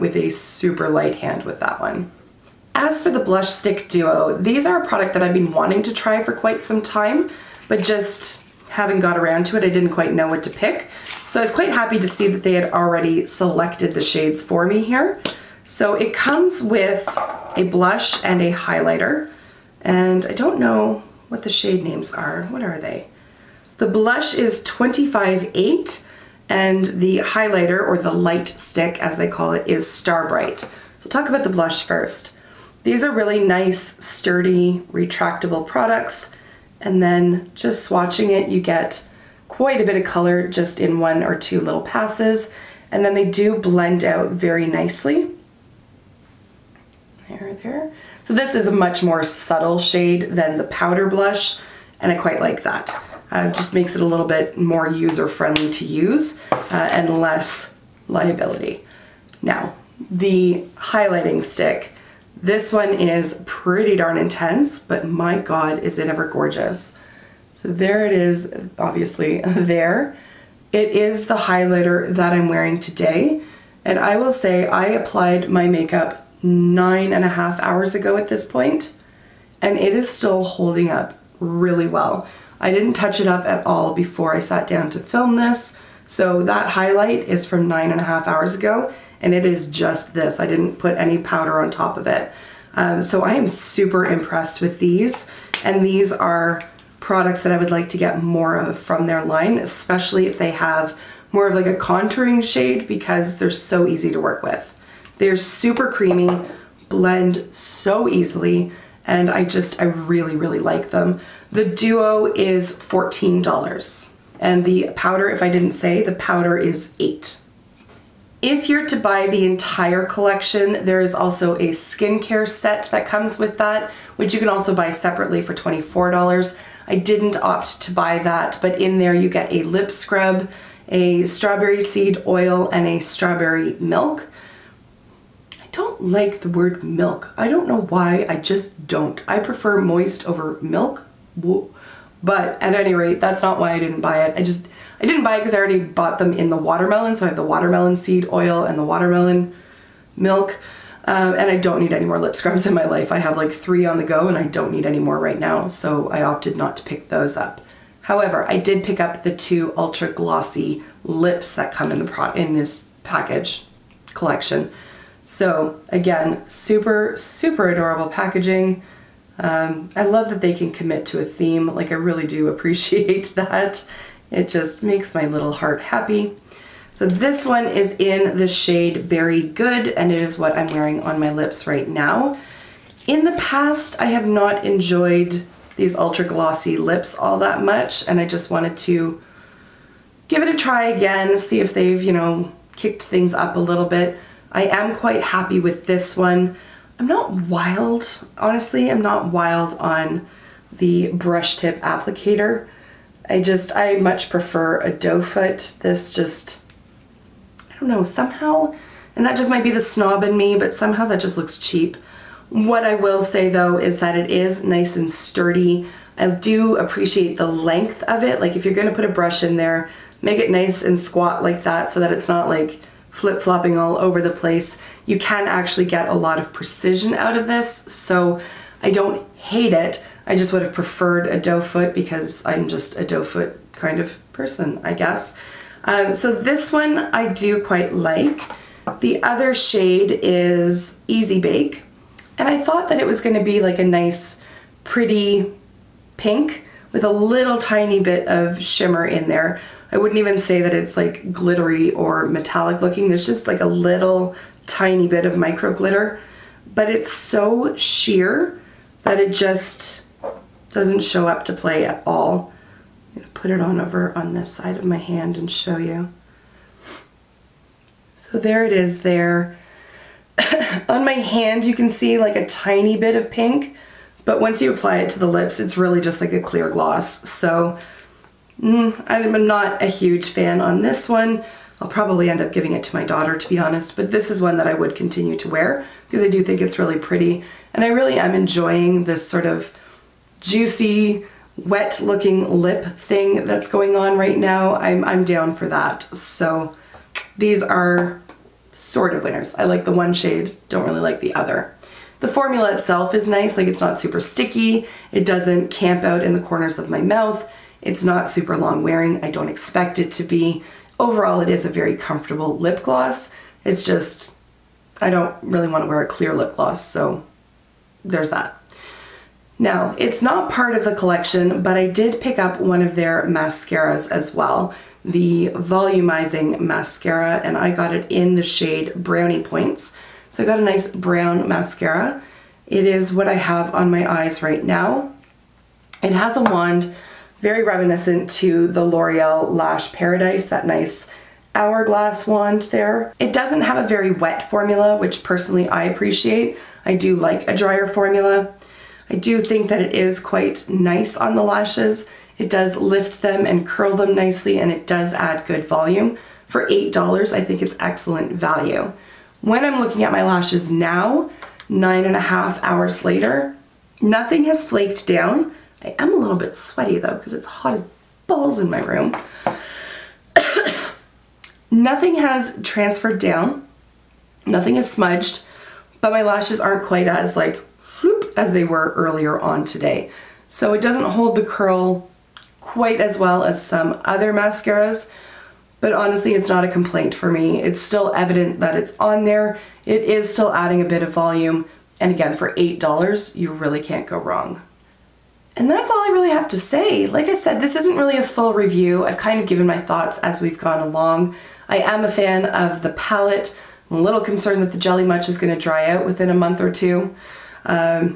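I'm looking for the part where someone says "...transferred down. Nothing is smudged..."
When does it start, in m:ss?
6:12.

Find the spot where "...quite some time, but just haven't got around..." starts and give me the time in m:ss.
0:06.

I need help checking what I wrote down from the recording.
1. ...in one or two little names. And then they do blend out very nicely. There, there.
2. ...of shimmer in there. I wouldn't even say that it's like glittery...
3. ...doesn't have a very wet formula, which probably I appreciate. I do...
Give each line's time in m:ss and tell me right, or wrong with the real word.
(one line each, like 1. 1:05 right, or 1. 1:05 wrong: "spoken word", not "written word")
1. 0:40 wrong: "passes", not "names"
2. 4:08 right
3. 5:43 wrong: "personally", not "probably".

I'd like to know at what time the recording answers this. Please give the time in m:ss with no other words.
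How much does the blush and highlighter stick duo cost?
1:52.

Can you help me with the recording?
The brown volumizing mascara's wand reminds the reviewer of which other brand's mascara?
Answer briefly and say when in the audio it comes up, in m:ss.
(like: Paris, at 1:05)
L'Oreal Lash Paradise, at 5:38.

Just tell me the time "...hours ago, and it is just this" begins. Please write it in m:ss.
1:28.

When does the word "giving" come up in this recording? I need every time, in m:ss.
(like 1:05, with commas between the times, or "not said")
4:42.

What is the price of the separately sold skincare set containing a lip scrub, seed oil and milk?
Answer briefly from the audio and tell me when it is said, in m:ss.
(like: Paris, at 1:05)
$24, at 2:05.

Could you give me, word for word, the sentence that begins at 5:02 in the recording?
The formula itself is nice, like it's not super sticky.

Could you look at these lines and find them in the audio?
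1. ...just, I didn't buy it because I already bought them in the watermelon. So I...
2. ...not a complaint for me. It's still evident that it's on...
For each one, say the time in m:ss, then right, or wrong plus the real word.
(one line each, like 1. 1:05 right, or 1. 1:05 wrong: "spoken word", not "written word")
1. 2:24 right
2. 6:26 right.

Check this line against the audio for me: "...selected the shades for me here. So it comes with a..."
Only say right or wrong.
right.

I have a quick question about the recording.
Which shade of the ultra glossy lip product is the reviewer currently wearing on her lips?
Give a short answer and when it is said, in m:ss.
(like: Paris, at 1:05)
Berry Good, at 2:59.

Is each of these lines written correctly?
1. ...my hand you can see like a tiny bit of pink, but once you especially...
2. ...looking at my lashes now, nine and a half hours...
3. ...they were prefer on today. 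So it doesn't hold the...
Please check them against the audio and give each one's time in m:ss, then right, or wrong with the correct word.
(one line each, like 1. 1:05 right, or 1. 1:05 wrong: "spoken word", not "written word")
1. 4:31 wrong: "apply", not "especially"
2. 5:59 right
3. 6:18 wrong: "earlier", not "prefer".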